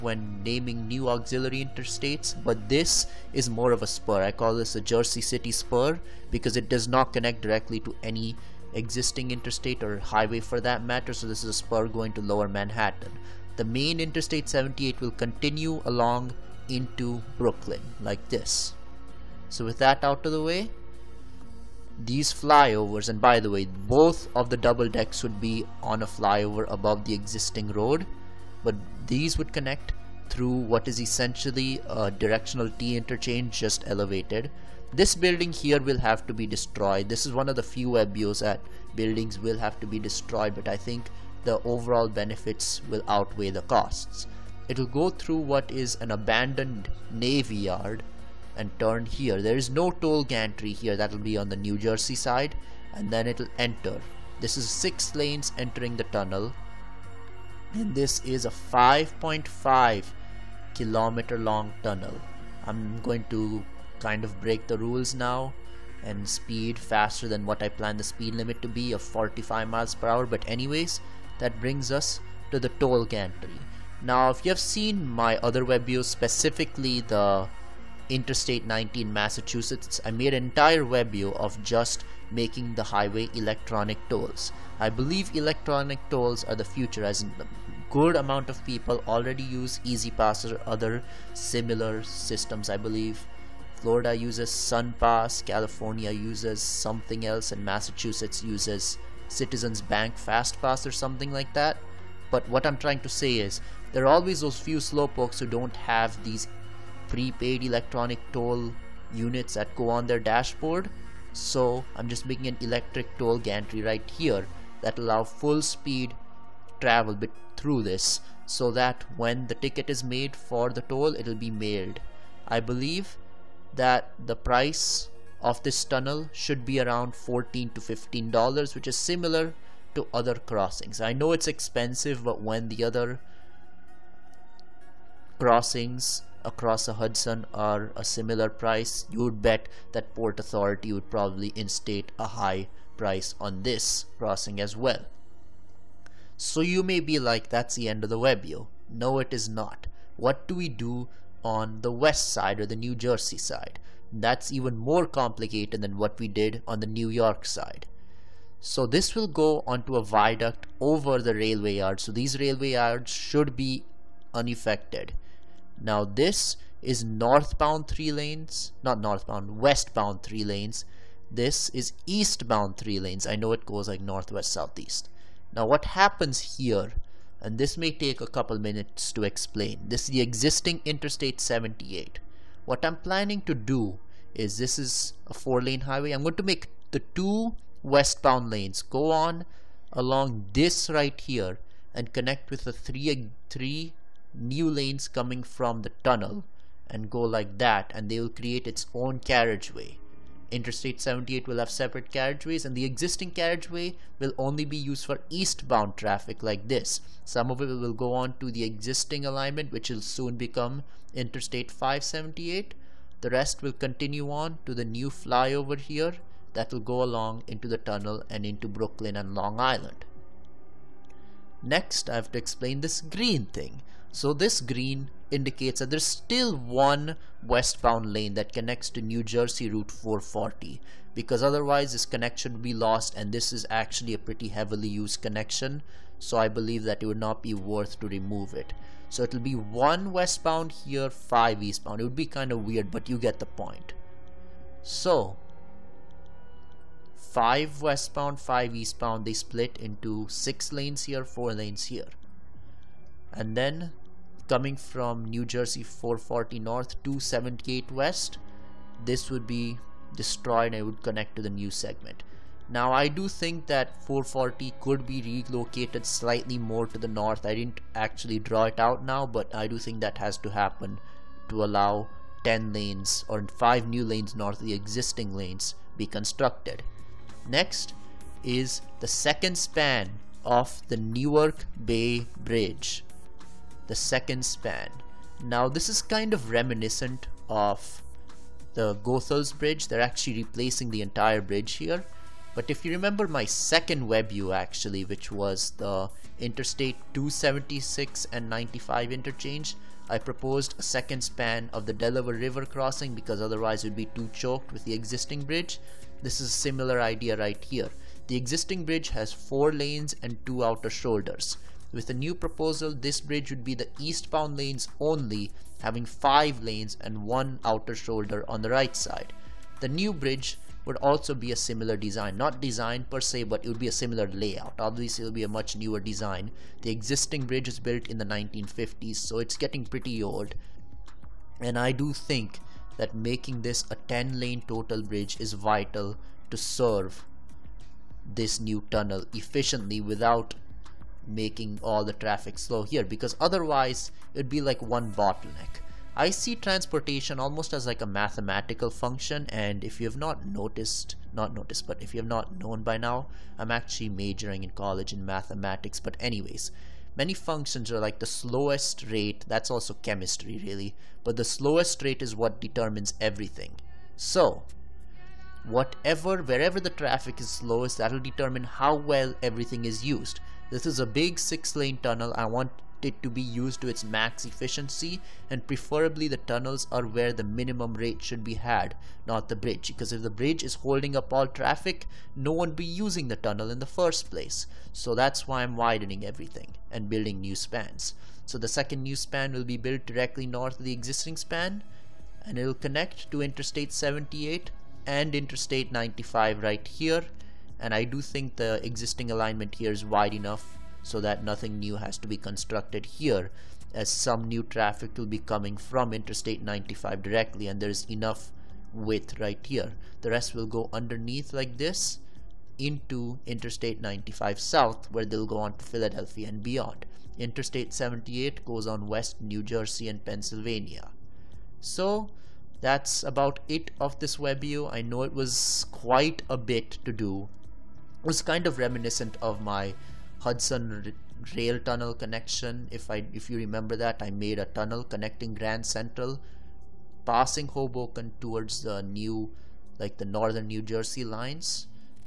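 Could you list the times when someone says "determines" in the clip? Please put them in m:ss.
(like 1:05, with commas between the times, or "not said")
6:02, 6:08.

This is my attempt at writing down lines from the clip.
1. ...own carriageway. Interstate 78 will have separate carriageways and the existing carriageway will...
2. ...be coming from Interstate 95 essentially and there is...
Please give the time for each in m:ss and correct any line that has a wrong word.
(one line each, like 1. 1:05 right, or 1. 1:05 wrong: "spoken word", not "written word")
1. 3:18 right
2. 6:45 wrong: "directly", not "essentially".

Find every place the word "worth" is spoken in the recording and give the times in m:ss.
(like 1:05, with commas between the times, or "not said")
3:57.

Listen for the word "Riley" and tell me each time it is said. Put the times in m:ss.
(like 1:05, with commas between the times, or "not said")
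not said.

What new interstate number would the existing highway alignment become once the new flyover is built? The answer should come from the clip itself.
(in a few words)
Interstate 578.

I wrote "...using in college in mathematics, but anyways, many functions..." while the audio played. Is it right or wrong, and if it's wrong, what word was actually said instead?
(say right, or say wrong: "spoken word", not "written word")
wrong: "majoring", not "using".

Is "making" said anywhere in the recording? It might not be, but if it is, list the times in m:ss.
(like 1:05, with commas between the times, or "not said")
1:22, 1:52, 5:33, 5:41.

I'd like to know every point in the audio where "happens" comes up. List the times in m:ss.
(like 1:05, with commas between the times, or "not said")
2:55, 4:30.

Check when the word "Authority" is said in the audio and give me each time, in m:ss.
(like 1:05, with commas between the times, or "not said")
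2:20.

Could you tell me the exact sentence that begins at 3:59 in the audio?
So it'll be one westbound here, five eastbound.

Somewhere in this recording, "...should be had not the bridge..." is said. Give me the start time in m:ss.
6:18.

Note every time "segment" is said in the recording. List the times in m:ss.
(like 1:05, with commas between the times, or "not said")
4:21.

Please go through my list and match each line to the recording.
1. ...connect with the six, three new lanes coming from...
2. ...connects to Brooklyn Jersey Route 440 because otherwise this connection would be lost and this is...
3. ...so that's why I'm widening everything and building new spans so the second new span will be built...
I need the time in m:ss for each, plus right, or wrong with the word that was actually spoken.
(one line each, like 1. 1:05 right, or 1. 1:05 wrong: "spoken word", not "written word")
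1. 3:12 wrong: "three", not "six"
2. 3:48 wrong: "New", not "Brooklyn"
3. 6:24 right.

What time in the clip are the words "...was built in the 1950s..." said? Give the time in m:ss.
5:27.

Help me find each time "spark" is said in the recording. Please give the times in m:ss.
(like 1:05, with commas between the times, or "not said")
not said.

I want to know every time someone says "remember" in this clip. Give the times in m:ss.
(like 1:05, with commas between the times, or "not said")
4:52, 7:13.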